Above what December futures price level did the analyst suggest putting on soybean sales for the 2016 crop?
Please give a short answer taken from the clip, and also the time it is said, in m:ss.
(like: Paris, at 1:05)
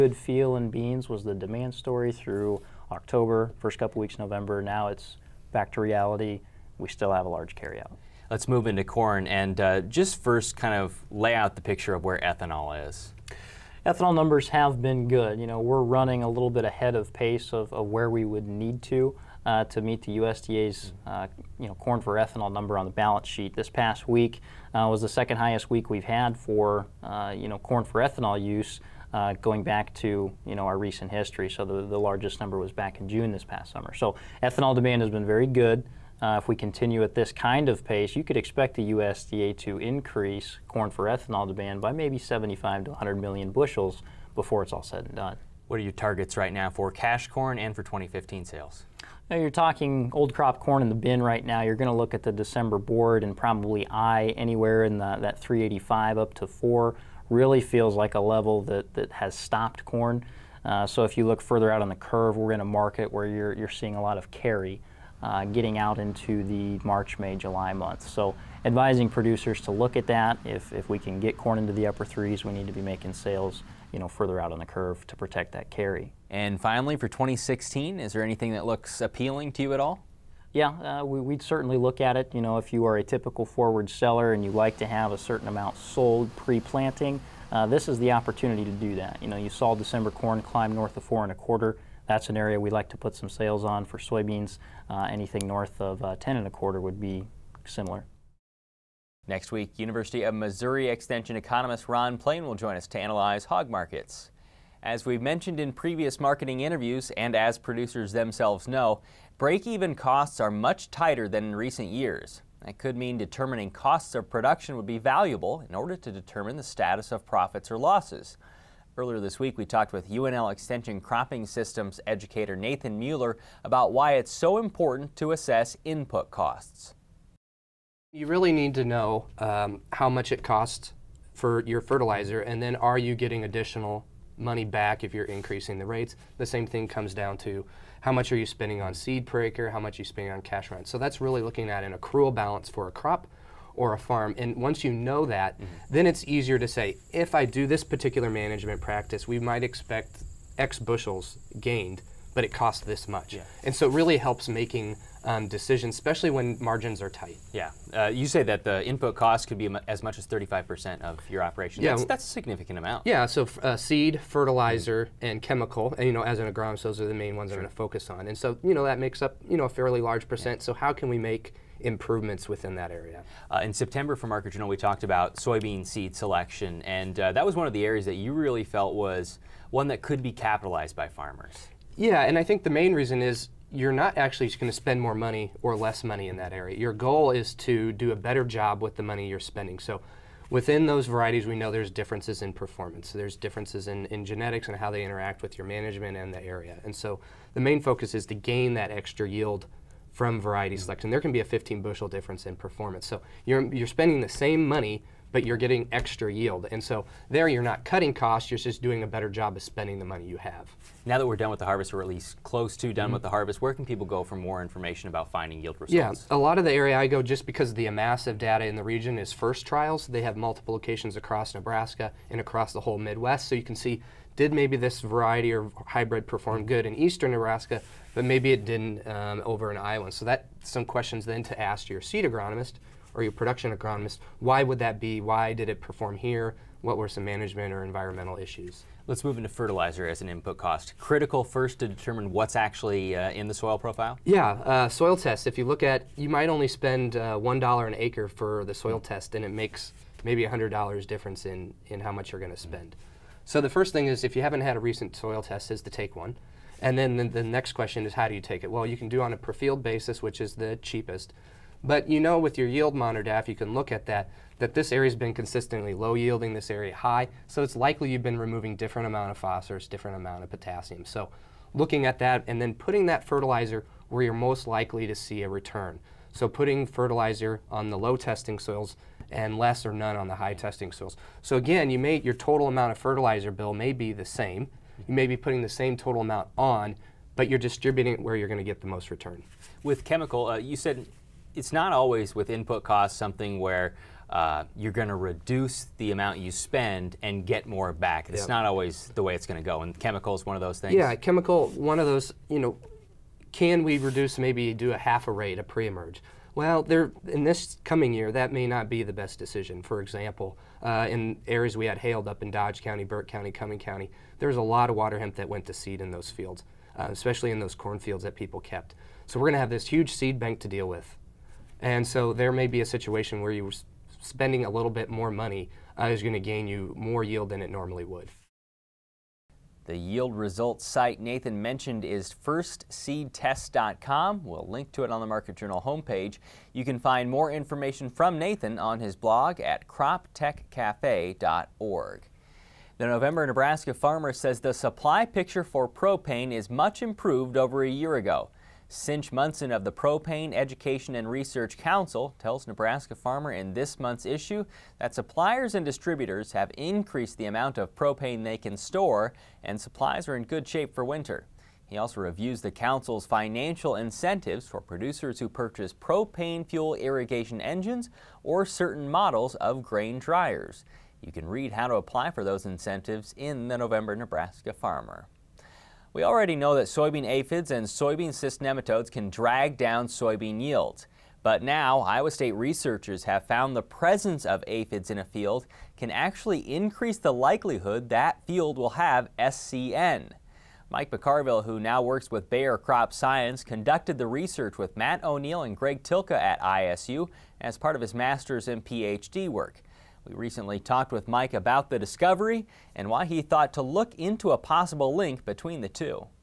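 10 and a quarter, at 1:36.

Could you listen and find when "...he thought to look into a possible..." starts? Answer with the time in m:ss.
6:43.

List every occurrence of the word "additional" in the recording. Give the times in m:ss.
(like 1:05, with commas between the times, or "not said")
2:13.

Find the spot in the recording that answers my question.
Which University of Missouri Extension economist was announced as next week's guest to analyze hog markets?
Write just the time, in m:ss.
1:41.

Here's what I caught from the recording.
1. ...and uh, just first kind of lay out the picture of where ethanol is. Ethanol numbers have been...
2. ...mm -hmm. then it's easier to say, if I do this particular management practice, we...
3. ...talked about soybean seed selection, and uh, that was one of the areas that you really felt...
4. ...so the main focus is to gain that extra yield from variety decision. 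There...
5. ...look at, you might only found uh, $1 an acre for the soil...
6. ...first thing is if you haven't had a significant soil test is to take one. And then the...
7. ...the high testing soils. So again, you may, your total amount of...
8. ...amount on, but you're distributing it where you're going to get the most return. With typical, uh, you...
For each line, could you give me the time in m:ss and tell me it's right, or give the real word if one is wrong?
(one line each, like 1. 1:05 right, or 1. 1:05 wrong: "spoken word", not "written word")
1. 0:09 right
2. 2:25 right
3. 2:54 right
4. 3:16 wrong: "selection", not "decision"
5. 4:05 wrong: "spend", not "found"
6. 4:13 wrong: "recent", not "significant"
7. 4:40 right
8. 4:46 wrong: "chemical", not "typical".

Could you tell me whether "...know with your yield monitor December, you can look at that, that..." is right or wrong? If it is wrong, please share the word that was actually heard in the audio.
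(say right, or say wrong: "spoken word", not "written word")
wrong: "DAF", not "December".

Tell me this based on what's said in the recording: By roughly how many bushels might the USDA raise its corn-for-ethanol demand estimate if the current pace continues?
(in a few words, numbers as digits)
75 to 100 million.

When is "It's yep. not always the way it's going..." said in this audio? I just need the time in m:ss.
4:58.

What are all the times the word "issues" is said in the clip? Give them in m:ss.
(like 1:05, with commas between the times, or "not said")
3:58, 5:54.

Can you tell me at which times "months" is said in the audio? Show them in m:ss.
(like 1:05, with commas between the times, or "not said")
1:07, 5:53.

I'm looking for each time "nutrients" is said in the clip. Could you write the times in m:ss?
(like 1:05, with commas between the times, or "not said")
not said.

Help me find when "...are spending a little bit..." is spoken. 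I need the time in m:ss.
5:23.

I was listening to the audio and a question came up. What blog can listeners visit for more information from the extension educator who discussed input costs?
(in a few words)
croptechcafe.org.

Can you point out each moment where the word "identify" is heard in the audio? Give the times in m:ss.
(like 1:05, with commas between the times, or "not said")
not said.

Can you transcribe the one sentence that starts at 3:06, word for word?
Your goal is to do a better job with the money you're spending.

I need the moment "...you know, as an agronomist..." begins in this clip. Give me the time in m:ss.
2:46.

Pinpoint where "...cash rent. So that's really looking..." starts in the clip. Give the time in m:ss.
2:20.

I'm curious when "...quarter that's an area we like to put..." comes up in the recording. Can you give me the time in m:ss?
1:31.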